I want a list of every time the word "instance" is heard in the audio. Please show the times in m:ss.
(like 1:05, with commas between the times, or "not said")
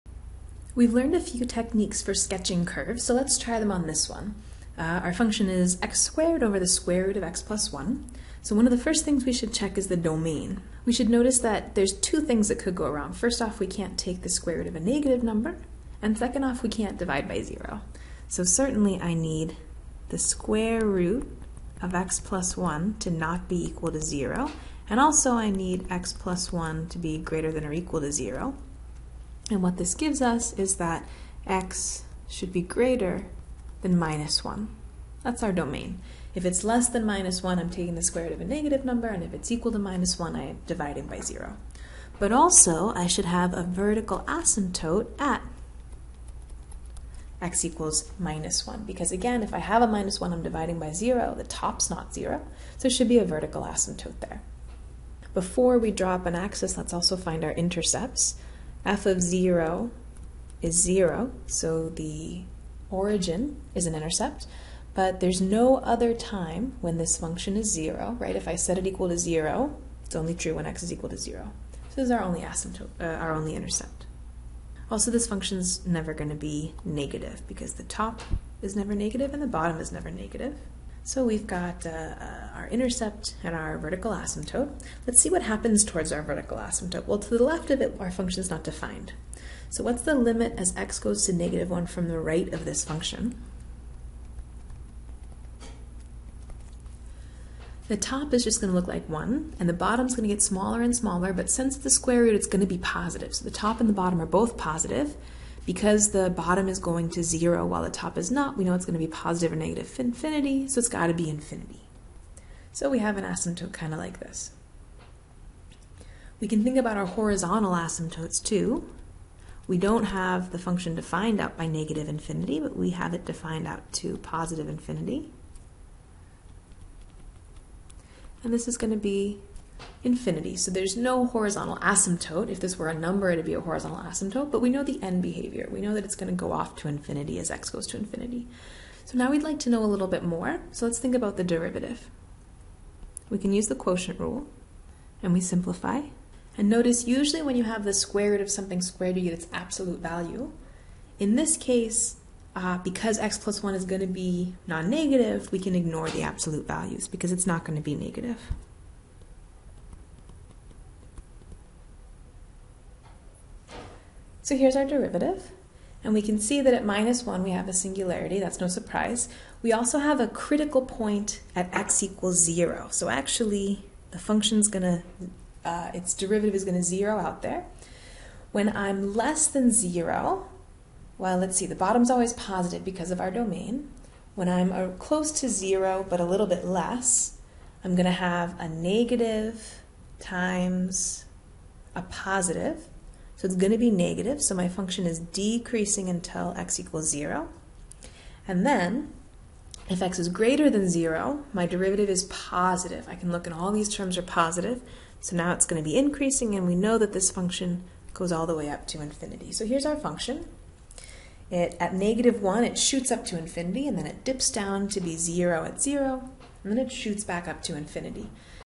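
not said.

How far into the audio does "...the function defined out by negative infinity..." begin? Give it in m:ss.
2:00.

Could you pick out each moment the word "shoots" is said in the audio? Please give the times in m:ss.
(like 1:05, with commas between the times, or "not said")
3:32, 3:36.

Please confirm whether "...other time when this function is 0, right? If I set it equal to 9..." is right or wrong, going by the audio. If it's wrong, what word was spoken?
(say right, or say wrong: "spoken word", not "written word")
wrong: "0", not "9".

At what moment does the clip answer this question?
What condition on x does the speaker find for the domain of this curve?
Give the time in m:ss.
0:31.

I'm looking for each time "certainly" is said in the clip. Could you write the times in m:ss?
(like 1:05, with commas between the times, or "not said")
0:18.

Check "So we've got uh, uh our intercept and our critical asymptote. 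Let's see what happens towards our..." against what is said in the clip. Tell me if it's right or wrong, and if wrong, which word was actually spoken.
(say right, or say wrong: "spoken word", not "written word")
wrong: "vertical", not "critical".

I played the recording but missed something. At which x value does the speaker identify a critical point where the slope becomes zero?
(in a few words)
0.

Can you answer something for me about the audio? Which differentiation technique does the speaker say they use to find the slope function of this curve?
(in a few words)
quotient rule.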